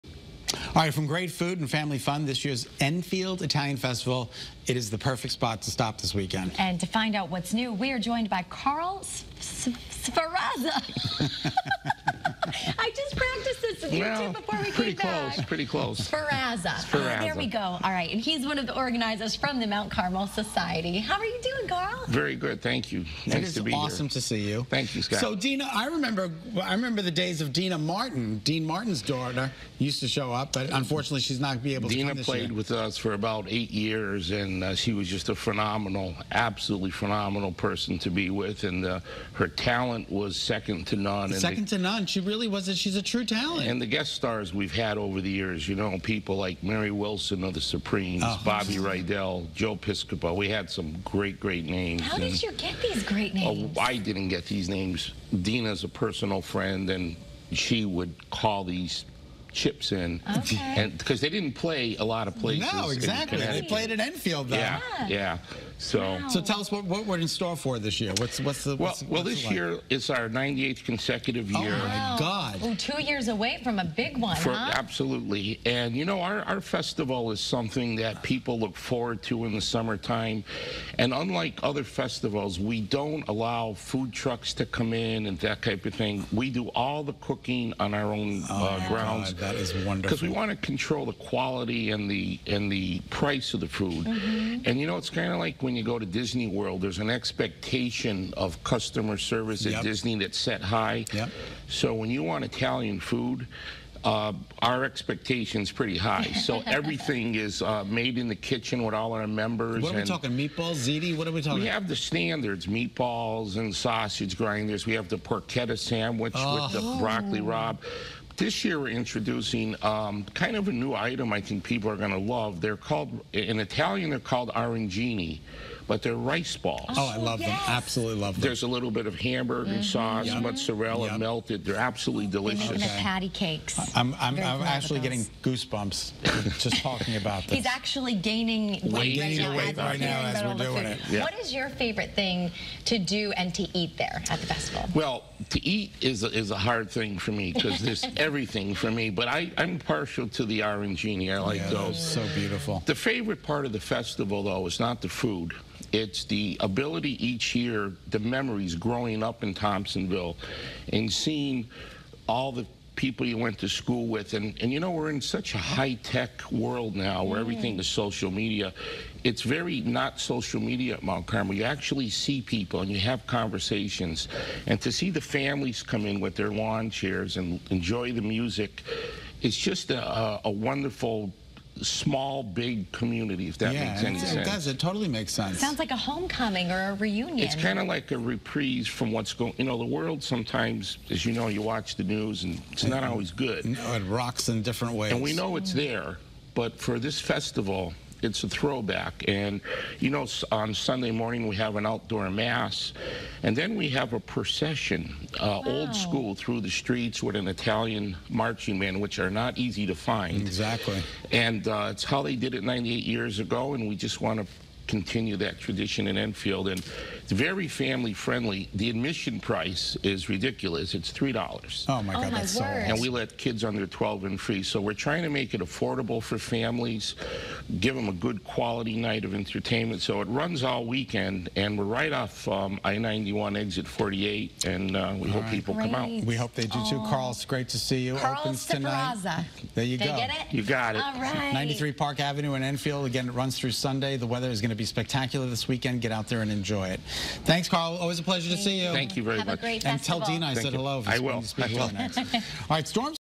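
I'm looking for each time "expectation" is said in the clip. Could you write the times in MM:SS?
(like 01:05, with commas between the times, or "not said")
01:37, 01:44.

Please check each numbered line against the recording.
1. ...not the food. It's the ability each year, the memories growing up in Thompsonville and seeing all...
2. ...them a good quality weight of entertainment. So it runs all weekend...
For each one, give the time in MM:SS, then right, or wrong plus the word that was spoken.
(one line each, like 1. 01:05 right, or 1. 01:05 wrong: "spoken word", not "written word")
1. 02:34 right
2. 03:47 wrong: "night", not "weight".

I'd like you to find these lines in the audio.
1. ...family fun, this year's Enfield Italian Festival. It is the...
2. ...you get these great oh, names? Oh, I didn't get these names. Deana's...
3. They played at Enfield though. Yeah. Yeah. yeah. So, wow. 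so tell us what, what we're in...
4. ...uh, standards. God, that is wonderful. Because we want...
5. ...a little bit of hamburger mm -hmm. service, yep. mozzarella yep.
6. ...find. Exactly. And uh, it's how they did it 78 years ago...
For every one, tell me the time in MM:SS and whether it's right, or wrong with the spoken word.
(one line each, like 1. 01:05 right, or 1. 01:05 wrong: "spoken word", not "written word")
1. 00:01 right
2. 00:52 right
3. 01:03 right
4. 01:28 wrong: "grounds", not "standards"
5. 02:08 wrong: "sauce", not "service"
6. 03:29 wrong: "98", not "78".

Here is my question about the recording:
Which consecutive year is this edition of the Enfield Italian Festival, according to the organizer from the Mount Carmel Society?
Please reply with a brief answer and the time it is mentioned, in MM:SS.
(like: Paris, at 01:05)
98th, at 01:10.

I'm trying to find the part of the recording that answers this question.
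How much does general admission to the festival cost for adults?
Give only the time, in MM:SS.
03:41.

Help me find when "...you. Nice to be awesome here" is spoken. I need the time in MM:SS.
00:22.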